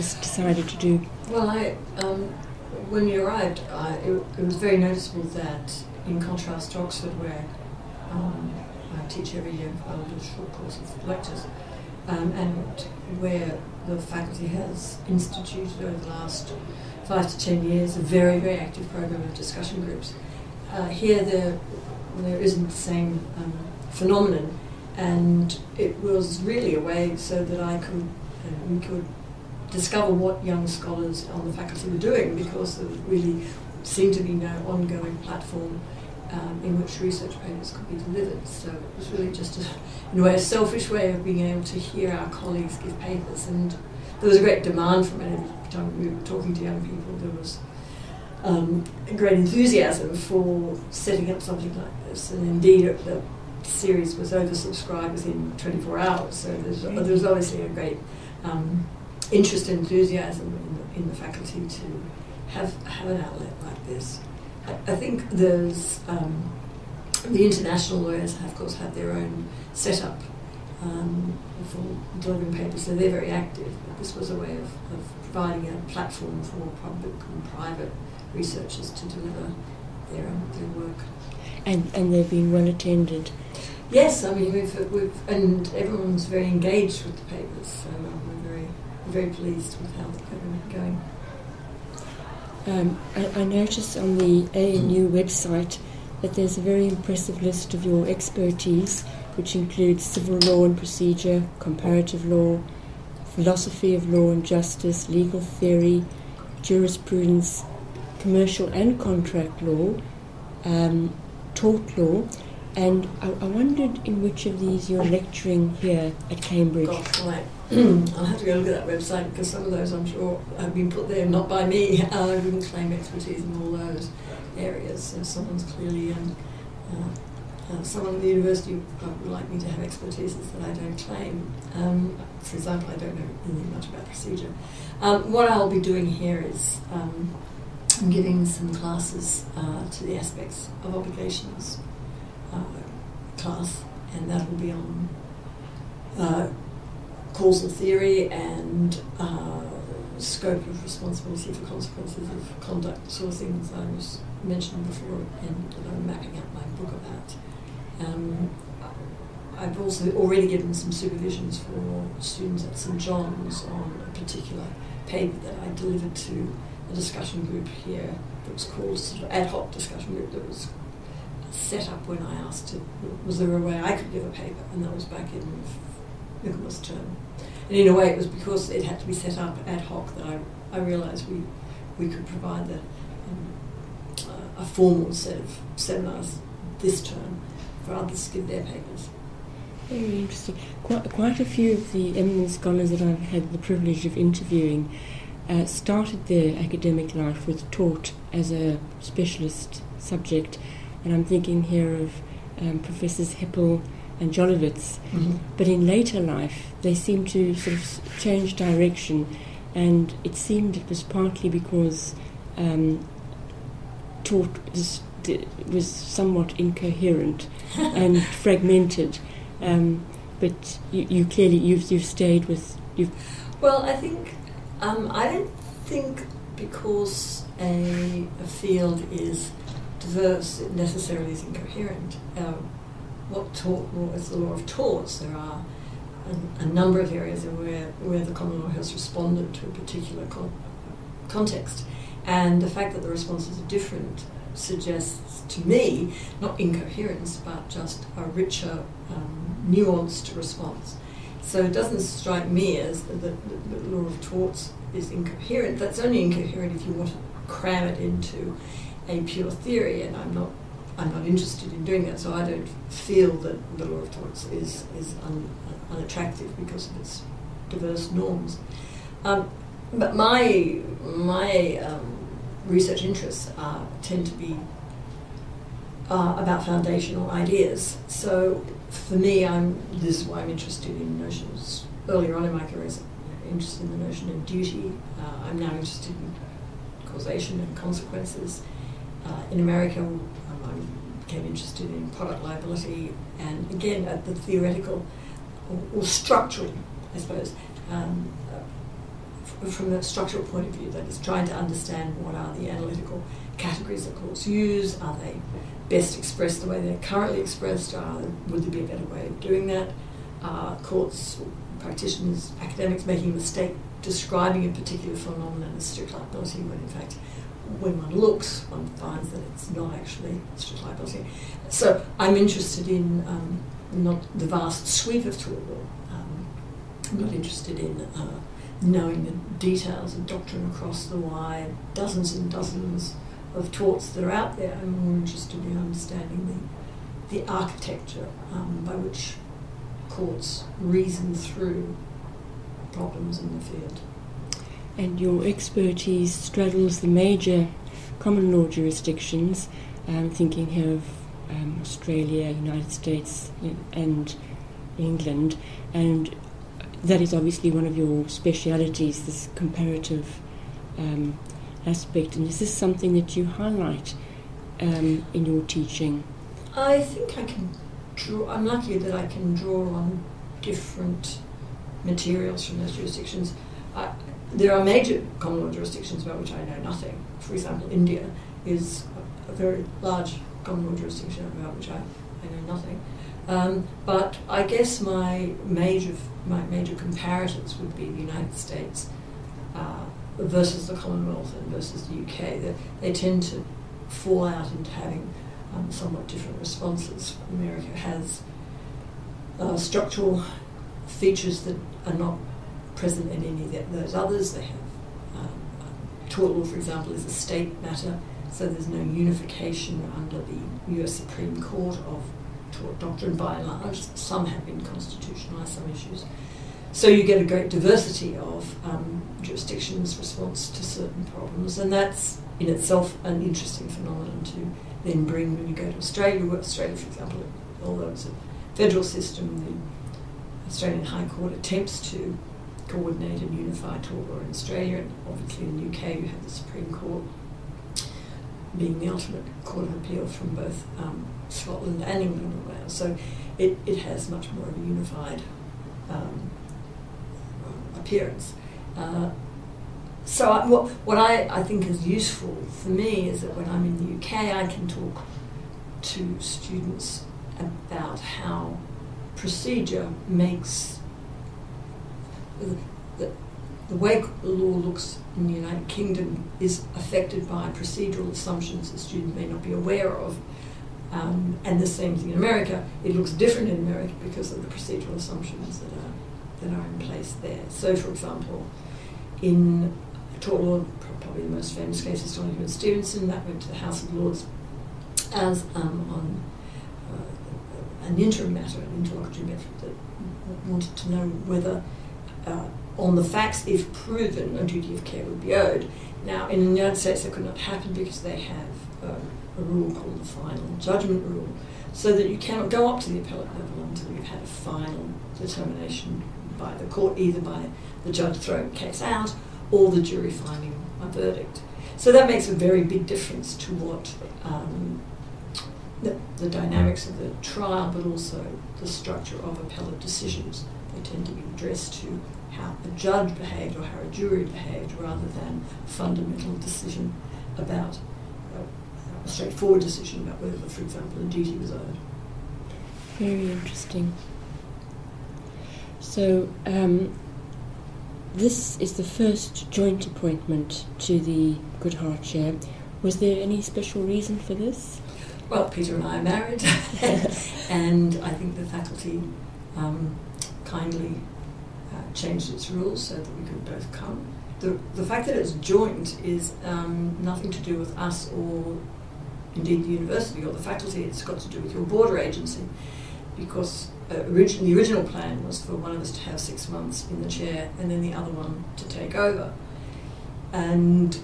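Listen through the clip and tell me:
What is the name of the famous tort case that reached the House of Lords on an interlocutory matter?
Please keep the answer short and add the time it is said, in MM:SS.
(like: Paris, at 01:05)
Donoghue and Stevenson, at 08:02.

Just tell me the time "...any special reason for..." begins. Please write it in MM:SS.
09:03.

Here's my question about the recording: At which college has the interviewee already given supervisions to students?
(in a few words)
St John's.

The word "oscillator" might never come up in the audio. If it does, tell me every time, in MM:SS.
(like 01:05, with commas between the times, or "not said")
not said.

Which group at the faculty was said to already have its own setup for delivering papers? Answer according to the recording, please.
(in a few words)
International lawyers.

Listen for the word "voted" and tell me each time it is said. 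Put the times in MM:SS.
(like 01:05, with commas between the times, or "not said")
not said.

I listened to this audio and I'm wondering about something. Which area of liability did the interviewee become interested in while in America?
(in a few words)
Product liability.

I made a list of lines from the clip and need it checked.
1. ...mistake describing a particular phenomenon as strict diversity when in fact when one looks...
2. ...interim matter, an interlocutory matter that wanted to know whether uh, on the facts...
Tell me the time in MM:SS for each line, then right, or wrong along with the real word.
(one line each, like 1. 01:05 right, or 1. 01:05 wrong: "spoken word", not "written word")
1. 05:13 wrong: "liability", not "diversity"
2. 08:08 right.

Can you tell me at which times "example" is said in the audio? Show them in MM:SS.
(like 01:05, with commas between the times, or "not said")
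02:12, 06:17, 06:46, 07:07, 07:58, 08:50.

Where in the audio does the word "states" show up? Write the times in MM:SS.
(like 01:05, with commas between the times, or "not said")
05:52, 06:28, 06:47, 08:16.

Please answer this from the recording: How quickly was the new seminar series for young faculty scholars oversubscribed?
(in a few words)
24 hours.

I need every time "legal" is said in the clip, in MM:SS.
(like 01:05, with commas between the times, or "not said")
01:45.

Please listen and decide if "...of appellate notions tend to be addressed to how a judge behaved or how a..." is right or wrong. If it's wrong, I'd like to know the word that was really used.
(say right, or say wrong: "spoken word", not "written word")
wrong: "decisions", not "notions".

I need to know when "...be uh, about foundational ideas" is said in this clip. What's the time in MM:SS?
04:34.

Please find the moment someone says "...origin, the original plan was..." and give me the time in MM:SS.
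09:24.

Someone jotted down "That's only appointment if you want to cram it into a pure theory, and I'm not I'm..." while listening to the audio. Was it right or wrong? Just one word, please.
wrong.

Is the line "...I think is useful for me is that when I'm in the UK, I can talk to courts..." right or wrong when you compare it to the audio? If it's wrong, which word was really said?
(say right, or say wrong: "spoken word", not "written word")
wrong: "students", not "courts".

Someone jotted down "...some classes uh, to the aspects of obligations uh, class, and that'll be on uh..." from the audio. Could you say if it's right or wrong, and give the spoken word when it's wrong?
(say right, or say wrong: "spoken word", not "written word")
right.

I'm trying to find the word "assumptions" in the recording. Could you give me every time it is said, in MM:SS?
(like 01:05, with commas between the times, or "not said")
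07:48, 07:55.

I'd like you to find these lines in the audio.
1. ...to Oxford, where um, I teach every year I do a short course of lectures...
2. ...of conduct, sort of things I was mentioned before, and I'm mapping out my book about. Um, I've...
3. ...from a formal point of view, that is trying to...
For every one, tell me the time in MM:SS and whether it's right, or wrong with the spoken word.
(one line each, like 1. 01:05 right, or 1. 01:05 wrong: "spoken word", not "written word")
1. 00:06 right
2. 02:32 right
3. 04:59 wrong: "structural", not "formal".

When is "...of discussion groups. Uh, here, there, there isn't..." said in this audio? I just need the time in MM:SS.
00:19.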